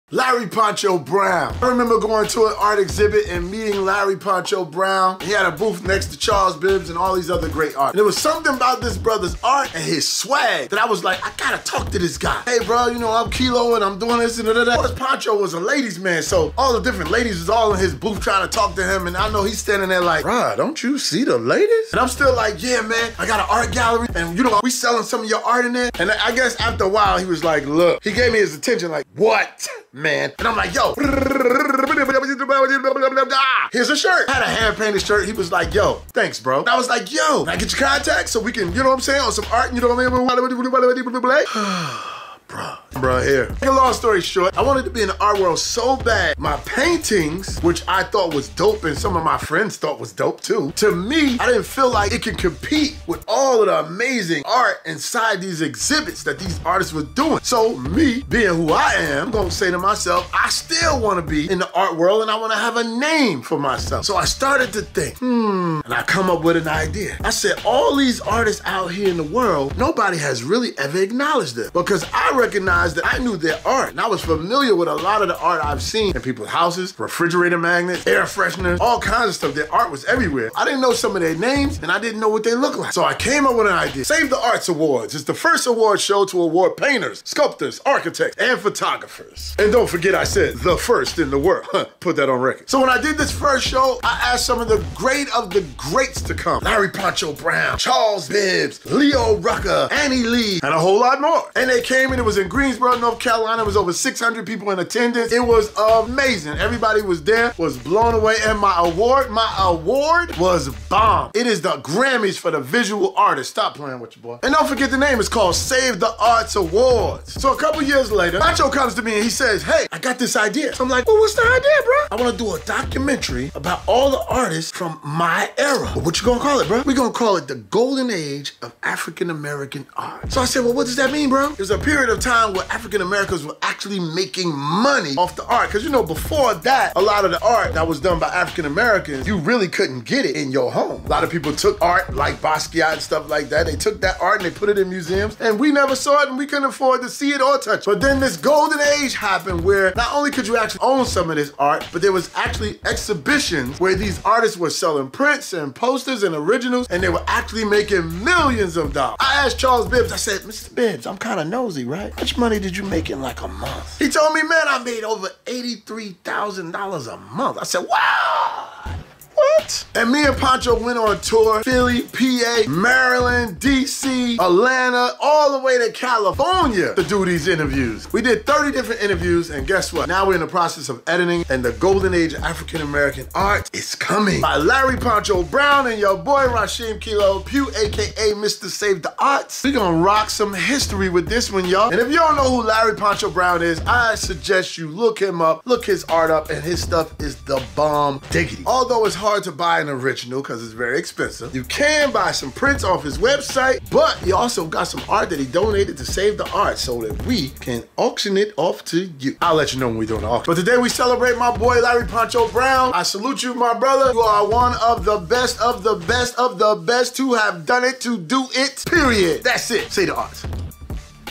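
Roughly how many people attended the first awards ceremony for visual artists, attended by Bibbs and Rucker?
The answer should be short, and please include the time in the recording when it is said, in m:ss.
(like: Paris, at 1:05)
Over 600, at 1:43.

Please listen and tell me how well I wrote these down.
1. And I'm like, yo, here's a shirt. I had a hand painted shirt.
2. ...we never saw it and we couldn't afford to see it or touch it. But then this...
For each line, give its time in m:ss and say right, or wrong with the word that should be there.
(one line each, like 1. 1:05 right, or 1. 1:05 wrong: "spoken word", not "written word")
1. 0:30 right
2. 2:25 right.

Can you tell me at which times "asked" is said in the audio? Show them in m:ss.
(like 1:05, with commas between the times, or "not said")
1:34, 2:39.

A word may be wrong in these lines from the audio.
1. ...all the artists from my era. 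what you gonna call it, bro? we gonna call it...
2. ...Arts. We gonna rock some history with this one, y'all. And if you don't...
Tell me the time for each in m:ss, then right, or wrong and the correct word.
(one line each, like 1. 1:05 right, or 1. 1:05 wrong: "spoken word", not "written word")
1. 2:03 right
2. 3:09 right.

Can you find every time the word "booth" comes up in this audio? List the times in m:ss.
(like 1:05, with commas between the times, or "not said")
0:05, 0:17.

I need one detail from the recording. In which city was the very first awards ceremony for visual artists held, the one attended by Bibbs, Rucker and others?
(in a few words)
Greensboro, North Carolina.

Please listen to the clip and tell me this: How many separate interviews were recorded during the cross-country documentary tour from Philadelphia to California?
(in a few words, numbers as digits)
30.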